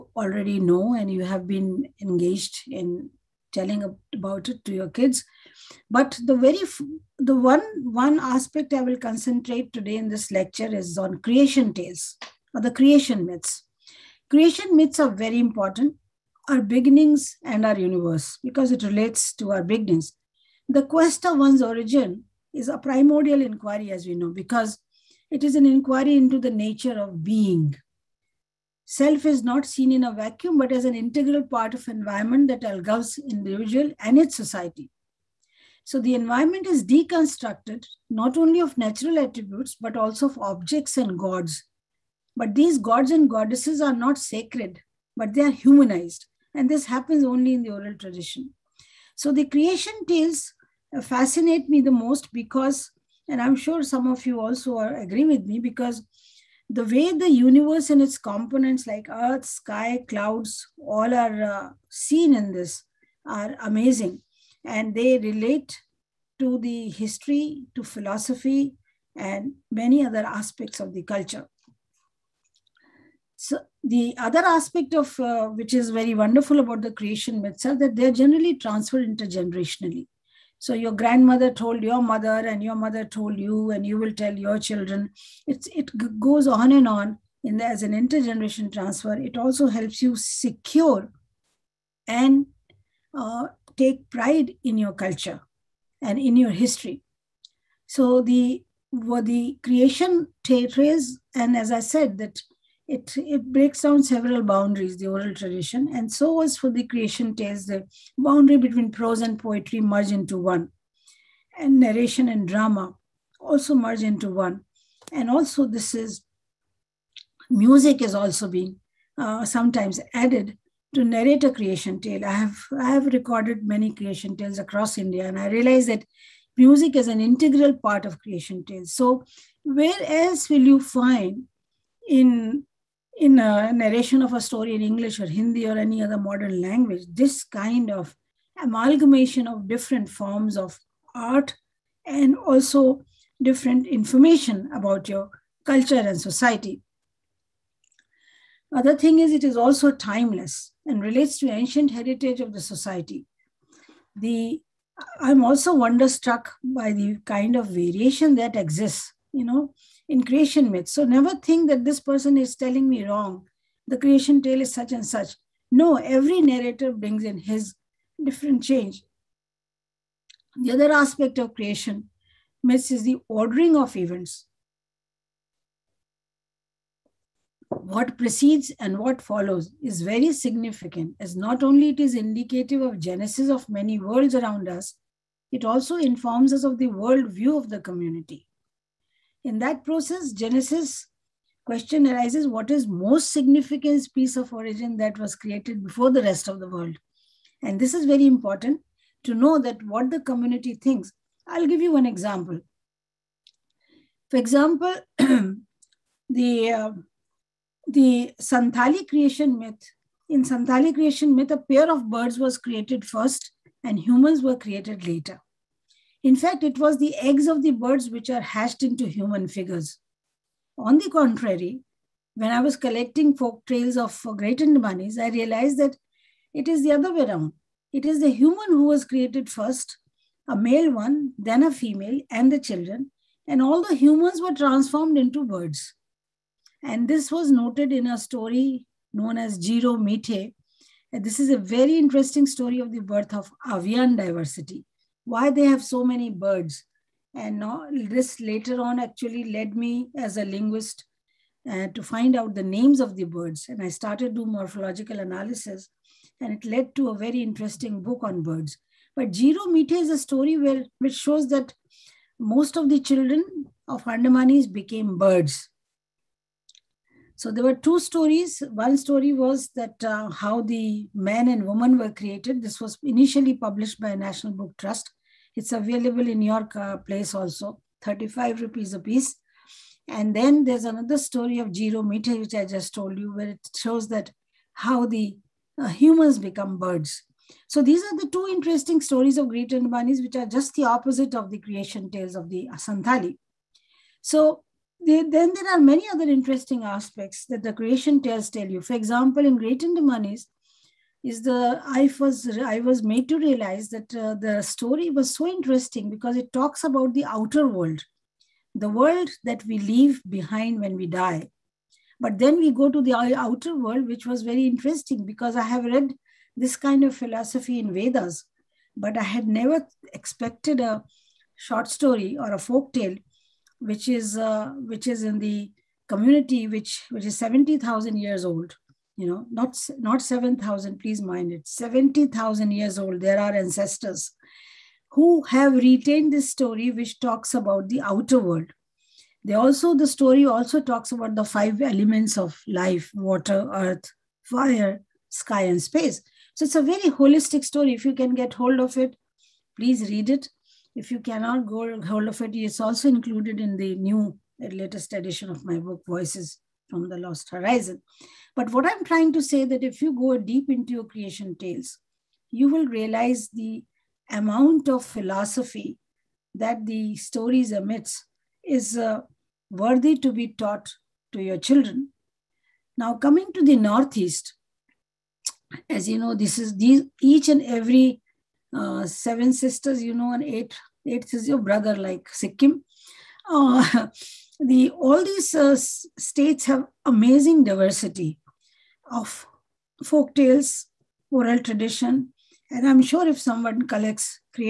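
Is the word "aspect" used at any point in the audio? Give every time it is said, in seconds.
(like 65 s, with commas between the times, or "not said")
8 s, 70 s, 74 s, 170 s, 296 s.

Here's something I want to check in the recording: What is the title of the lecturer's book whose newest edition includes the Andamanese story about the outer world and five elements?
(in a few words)
Voices from the Lost Horizon.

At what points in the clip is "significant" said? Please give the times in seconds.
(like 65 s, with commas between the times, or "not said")
180 s, 193 s.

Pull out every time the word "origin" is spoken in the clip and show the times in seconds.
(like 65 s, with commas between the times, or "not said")
21 s, 194 s.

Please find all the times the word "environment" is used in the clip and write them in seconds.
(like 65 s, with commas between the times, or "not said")
31 s, 36 s.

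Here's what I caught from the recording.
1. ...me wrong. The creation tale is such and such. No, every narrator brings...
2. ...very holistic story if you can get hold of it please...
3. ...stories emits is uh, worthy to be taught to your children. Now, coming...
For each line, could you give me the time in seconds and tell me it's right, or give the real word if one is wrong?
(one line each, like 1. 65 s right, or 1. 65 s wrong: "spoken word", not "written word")
1. 162 s right
2. 346 s right
3. 367 s right.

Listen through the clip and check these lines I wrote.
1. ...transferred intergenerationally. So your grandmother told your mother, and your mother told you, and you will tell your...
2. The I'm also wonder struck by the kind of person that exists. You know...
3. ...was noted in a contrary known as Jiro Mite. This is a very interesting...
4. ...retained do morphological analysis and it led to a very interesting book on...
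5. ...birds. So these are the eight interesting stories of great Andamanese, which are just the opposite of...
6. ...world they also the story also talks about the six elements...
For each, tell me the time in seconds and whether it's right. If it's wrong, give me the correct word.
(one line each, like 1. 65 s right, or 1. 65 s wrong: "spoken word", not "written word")
1. 78 s right
2. 154 s wrong: "variation", not "person"
3. 237 s wrong: "story", not "contrary"
4. 253 s wrong: "started", not "retained"
5. 286 s wrong: "two", not "eight"
6. 338 s wrong: "five", not "six".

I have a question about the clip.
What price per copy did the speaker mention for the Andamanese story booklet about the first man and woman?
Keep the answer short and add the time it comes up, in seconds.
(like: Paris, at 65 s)
35 rupees, at 278 s.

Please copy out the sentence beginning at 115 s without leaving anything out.
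And also, this is music is also being uh, sometimes added to narrate a creation tale.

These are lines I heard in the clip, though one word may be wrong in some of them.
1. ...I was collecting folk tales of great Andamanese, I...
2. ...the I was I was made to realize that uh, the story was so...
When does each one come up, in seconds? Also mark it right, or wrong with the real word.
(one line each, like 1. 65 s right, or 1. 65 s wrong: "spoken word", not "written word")
1. 222 s right
2. 301 s right.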